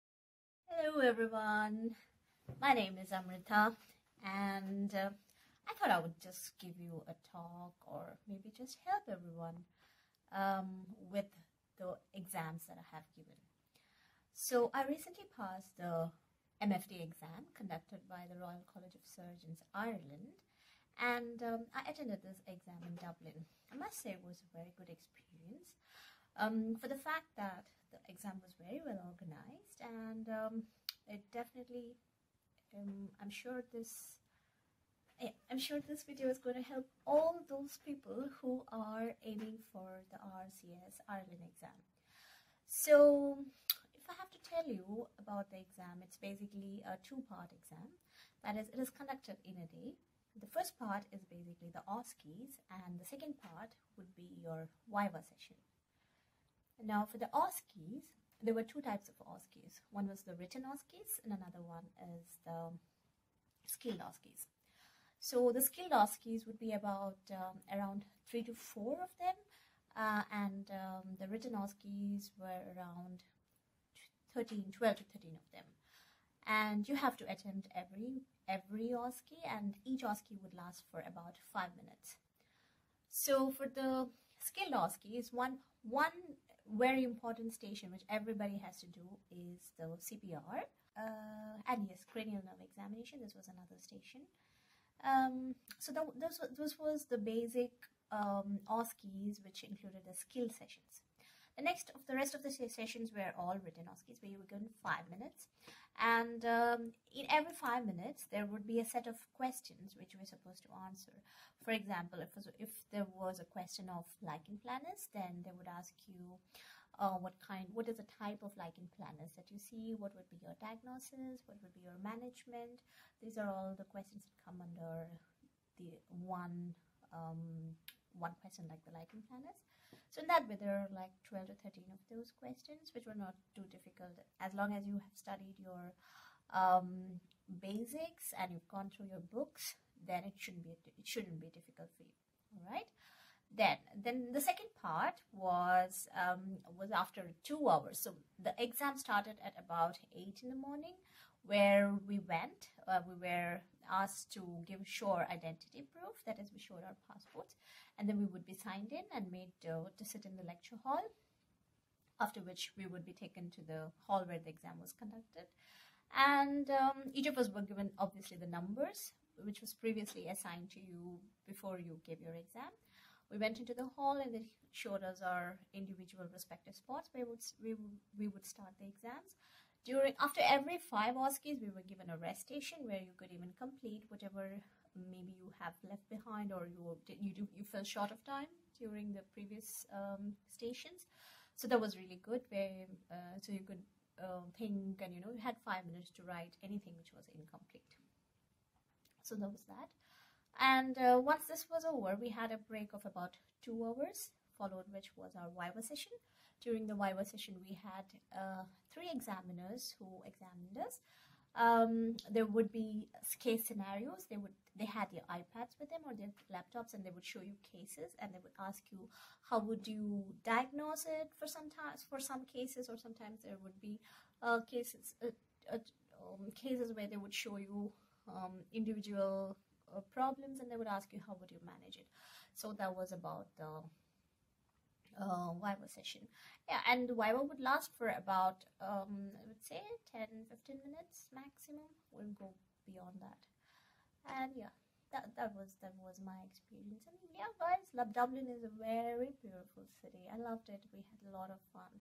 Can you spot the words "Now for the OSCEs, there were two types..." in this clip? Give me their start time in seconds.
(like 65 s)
56 s.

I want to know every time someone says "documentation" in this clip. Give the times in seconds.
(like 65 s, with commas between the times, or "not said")
not said.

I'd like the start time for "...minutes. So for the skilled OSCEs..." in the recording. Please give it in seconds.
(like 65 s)
81 s.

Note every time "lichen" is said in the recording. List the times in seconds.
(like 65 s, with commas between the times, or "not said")
114 s, 118 s, 128 s.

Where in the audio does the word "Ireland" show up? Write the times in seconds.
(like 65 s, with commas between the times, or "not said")
19 s, 41 s.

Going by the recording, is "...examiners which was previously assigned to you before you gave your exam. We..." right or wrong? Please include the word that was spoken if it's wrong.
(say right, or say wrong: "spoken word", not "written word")
wrong: "numbers", not "examiners".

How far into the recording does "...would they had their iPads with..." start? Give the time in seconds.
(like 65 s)
214 s.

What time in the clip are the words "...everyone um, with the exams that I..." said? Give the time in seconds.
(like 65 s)
9 s.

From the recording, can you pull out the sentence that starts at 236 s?
Yeah, and Viva would last for about, um, I would say 10 15 minutes maximum.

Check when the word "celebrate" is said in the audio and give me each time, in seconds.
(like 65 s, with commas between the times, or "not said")
not said.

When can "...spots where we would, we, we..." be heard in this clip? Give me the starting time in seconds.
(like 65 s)
176 s.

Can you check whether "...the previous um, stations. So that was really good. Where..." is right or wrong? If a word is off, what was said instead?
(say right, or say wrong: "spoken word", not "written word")
right.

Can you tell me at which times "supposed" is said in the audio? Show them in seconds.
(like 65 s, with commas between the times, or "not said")
110 s.